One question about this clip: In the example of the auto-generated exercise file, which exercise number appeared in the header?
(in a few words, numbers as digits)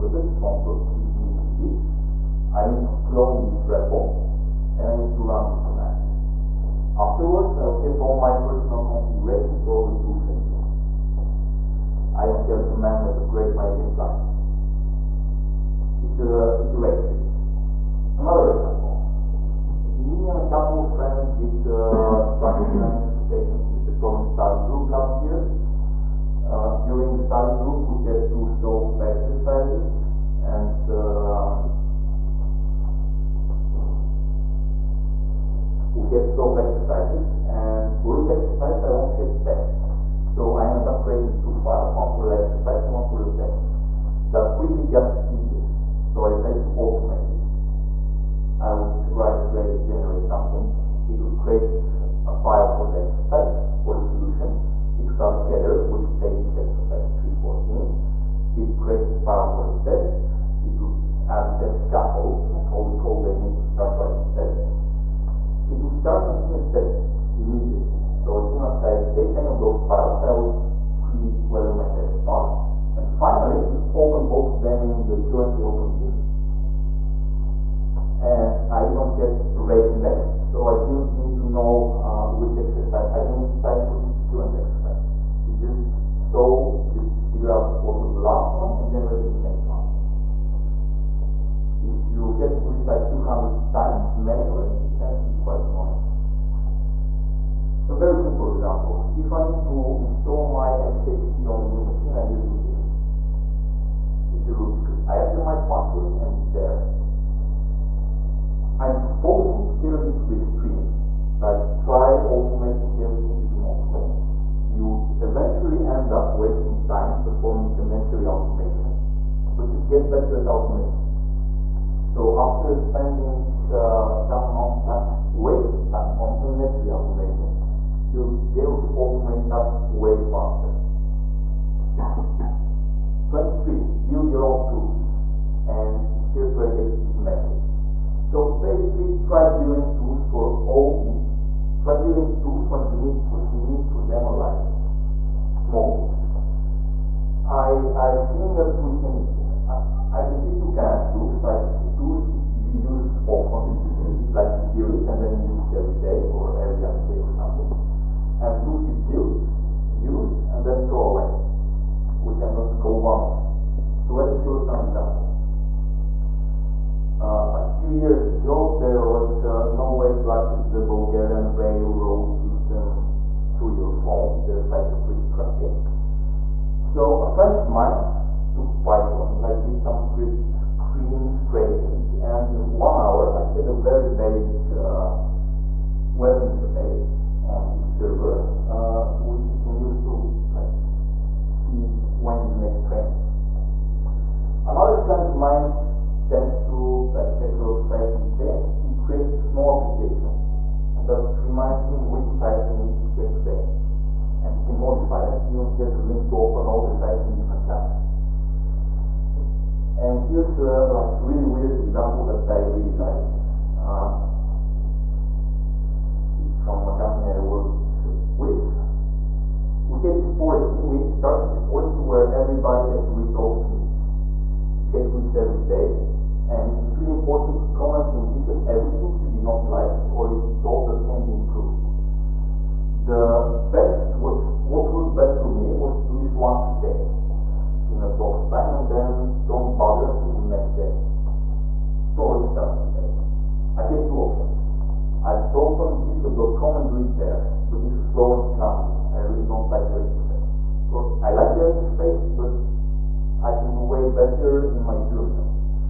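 314.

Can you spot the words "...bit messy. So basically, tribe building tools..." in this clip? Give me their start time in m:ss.
2:17.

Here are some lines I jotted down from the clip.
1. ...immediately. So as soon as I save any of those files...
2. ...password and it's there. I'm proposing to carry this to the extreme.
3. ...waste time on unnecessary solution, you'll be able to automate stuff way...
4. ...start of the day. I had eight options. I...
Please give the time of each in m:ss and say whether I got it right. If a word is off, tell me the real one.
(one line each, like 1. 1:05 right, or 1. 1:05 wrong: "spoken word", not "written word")
1. 1:07 right
2. 1:45 right
3. 2:05 wrong: "automation", not "solution"
4. 4:02 wrong: "two", not "eight".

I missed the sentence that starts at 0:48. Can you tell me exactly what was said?
I would write rake to generate something, it would create a file for the exercise, for the solution.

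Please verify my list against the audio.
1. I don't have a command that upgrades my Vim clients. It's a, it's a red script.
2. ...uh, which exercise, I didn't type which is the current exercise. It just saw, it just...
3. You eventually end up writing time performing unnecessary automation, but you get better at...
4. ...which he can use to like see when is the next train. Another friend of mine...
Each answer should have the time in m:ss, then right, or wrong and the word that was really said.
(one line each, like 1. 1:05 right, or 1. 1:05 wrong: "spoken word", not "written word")
1. 0:12 right
2. 1:22 right
3. 1:54 wrong: "wasting", not "writing"
4. 3:09 right.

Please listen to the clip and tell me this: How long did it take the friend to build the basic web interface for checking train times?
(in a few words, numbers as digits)
1 hour.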